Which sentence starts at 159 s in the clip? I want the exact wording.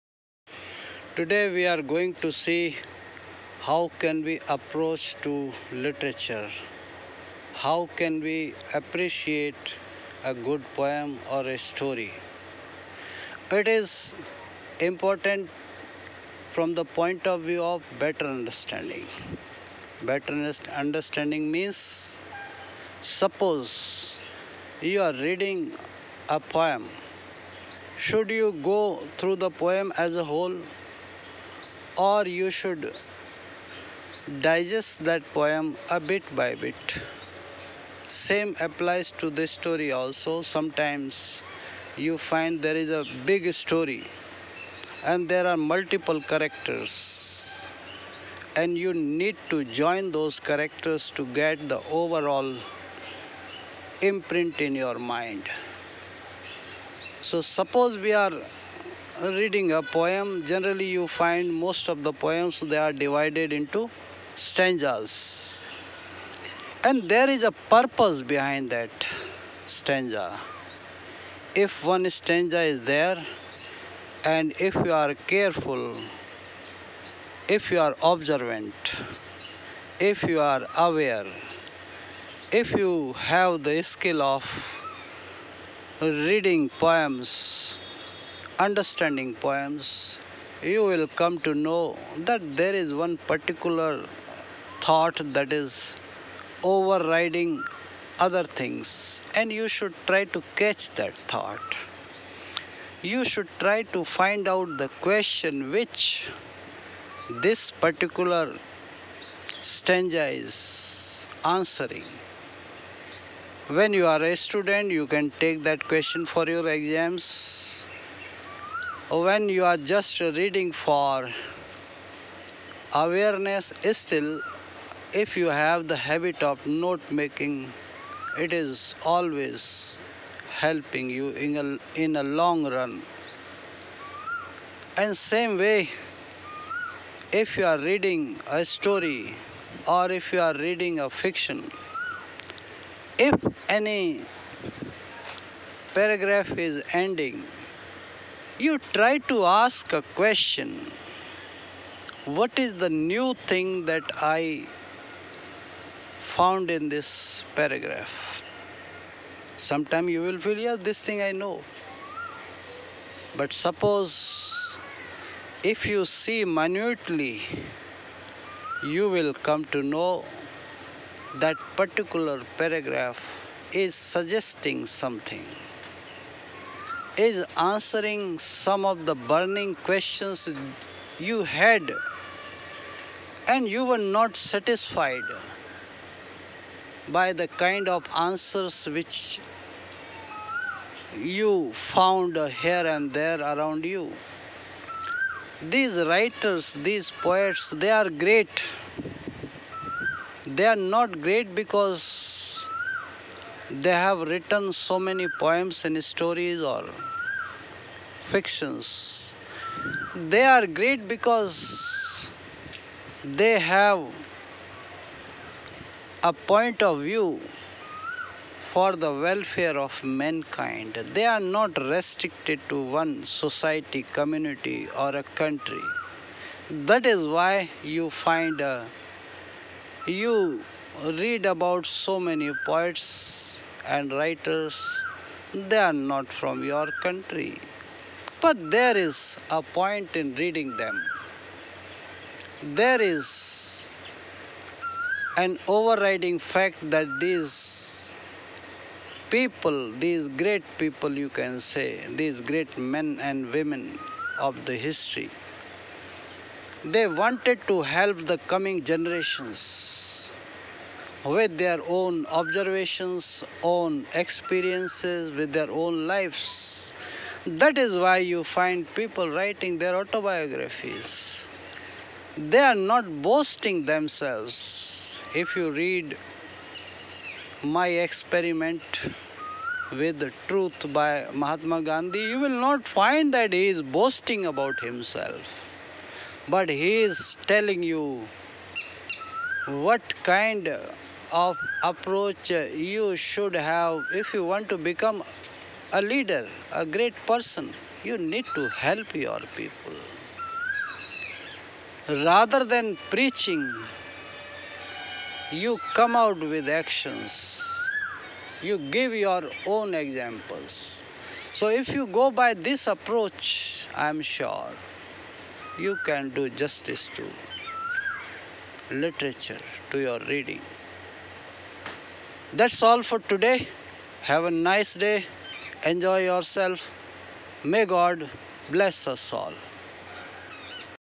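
Sometime you will feel, yeah, this thing I know.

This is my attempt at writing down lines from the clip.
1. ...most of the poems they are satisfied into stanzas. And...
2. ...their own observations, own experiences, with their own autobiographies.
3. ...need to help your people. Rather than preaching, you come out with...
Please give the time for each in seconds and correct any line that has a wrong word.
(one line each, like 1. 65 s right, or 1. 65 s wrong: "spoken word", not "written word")
1. 61 s wrong: "divided", not "satisfied"
2. 261 s wrong: "lives", not "autobiographies"
3. 298 s right.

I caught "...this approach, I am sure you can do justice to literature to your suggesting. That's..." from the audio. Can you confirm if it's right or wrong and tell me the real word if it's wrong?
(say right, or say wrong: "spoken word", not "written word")
wrong: "reading", not "suggesting".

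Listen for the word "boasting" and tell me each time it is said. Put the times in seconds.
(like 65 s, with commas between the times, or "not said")
273 s, 283 s.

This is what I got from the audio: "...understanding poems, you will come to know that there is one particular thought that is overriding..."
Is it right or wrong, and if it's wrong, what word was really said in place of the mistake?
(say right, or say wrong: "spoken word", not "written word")
right.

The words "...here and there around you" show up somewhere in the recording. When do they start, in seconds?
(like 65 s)
192 s.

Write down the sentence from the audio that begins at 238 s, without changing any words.
But there is a point in reading them.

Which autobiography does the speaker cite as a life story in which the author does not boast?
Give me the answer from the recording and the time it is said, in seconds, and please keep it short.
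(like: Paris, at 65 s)
My Experiment with the Truth, at 277 s.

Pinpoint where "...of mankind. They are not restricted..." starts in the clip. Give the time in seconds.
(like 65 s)
219 s.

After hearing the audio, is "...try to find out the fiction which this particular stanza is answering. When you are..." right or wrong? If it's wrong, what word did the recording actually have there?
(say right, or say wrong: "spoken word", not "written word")
wrong: "question", not "fiction".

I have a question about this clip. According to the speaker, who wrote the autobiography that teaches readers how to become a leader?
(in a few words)
Mahatma Gandhi.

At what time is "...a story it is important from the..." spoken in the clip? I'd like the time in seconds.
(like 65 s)
11 s.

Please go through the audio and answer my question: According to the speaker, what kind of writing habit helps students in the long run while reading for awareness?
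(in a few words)
note making.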